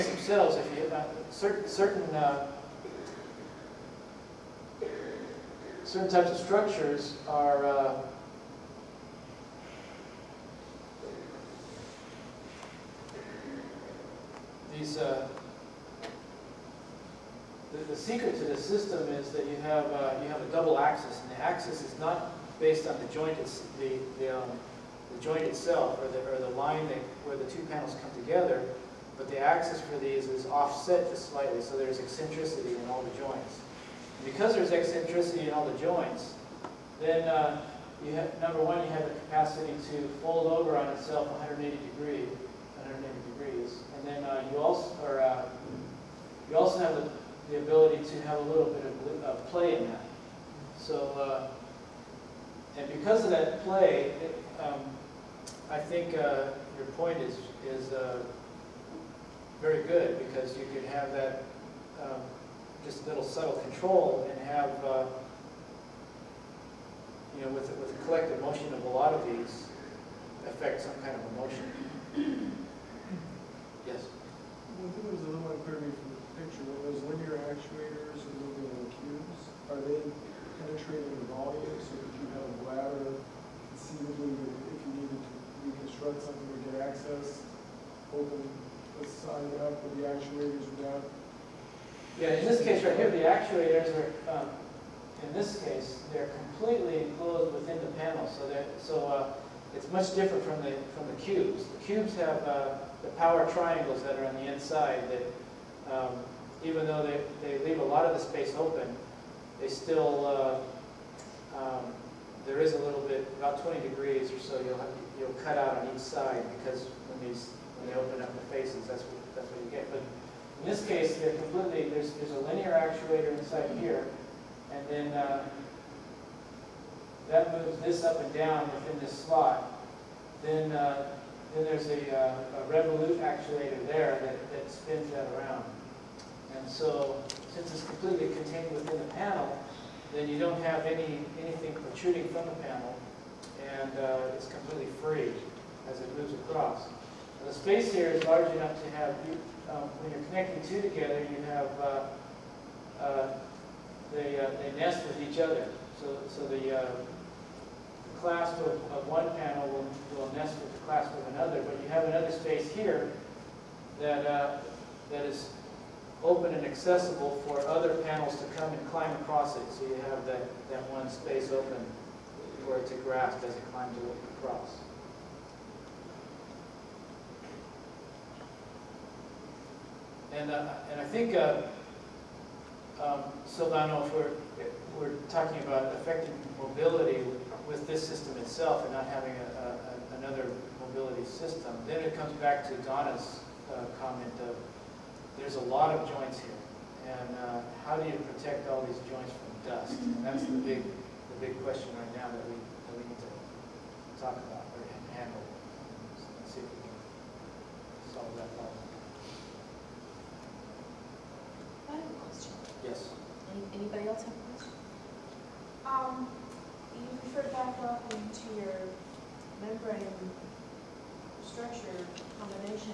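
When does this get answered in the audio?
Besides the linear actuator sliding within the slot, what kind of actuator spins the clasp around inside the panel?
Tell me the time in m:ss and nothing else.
2:12.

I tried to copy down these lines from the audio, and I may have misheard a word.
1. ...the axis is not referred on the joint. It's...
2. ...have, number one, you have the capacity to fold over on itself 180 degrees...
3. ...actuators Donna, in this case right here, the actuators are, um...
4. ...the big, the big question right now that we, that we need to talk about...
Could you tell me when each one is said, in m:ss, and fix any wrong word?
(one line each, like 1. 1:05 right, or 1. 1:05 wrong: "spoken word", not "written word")
1. 0:21 wrong: "based", not "referred"
2. 0:38 right
3. 1:30 wrong: "Yeah", not "Donna"
4. 3:20 right.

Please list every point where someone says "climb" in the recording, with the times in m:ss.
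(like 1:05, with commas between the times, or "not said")
2:48, 2:53.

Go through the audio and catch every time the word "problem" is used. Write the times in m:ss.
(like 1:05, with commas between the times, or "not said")
3:28.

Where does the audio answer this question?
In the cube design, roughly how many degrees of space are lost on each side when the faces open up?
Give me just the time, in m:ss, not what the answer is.
1:53.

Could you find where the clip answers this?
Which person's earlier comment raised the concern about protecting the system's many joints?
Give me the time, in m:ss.
3:12.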